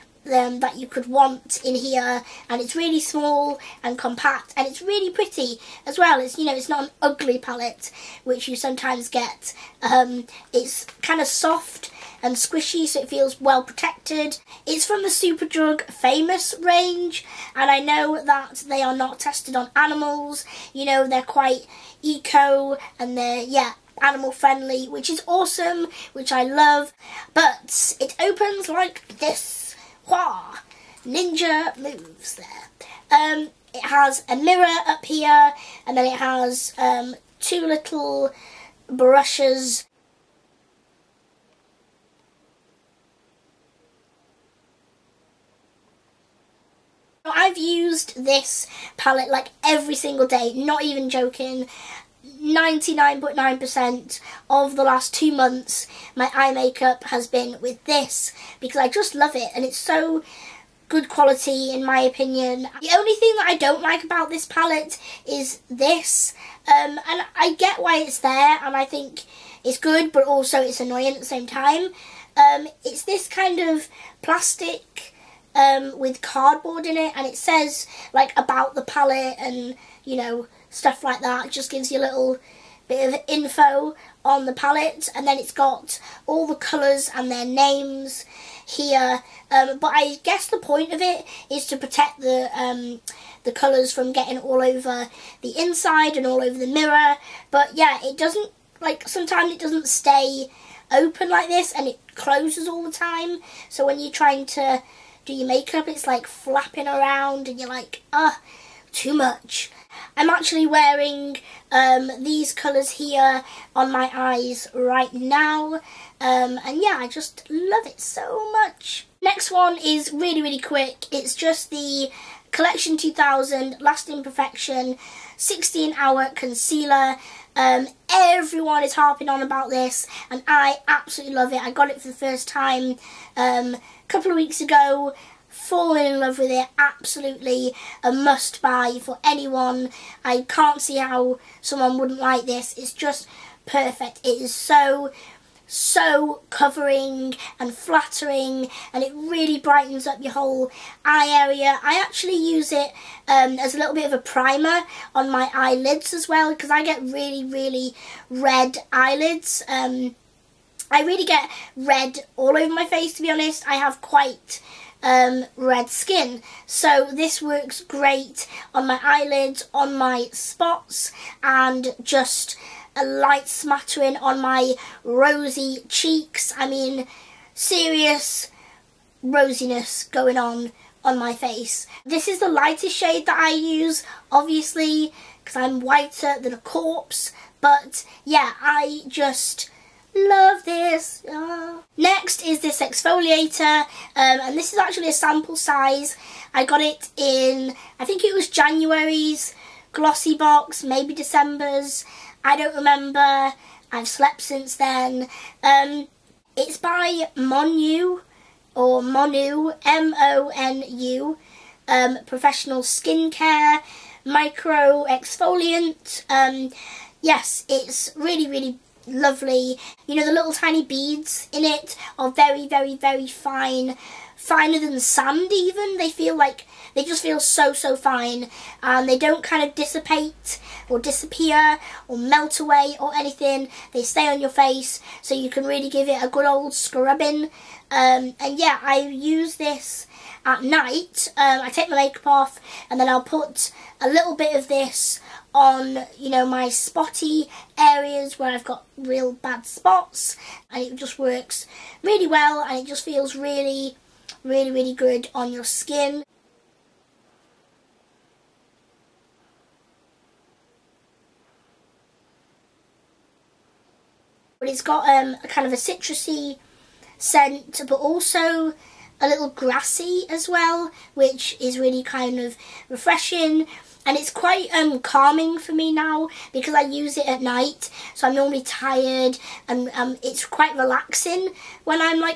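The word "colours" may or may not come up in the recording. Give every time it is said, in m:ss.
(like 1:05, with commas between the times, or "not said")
1:26, 1:33, 1:52.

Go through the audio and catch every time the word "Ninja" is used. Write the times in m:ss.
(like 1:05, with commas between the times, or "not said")
0:31.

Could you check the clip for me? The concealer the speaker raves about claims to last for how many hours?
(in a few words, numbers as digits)
16.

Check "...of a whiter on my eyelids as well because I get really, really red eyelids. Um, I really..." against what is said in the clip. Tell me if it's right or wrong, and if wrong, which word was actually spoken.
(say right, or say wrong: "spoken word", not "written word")
wrong: "primer", not "whiter".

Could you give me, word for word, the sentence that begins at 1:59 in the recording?
Next one is really, really quick.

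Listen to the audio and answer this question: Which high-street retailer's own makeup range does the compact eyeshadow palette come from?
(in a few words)
Superdrug.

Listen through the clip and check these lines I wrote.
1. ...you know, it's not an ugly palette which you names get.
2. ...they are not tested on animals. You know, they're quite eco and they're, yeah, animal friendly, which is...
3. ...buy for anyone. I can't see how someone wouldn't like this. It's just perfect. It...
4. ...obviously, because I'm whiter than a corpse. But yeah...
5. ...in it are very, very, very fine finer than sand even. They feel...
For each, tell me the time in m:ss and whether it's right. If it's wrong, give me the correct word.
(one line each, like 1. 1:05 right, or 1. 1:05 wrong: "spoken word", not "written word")
1. 0:06 wrong: "sometimes", not "names"
2. 0:18 right
3. 2:18 right
4. 3:04 right
5. 3:41 right.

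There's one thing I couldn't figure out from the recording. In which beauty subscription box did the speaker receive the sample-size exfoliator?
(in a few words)
Glossybox.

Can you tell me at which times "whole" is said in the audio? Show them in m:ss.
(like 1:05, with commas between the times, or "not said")
2:30.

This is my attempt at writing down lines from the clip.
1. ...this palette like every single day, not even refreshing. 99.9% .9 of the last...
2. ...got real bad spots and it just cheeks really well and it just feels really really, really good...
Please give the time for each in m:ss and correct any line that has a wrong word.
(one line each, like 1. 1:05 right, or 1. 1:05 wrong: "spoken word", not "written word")
1. 0:48 wrong: "joking", not "refreshing"
2. 4:08 wrong: "works", not "cheeks".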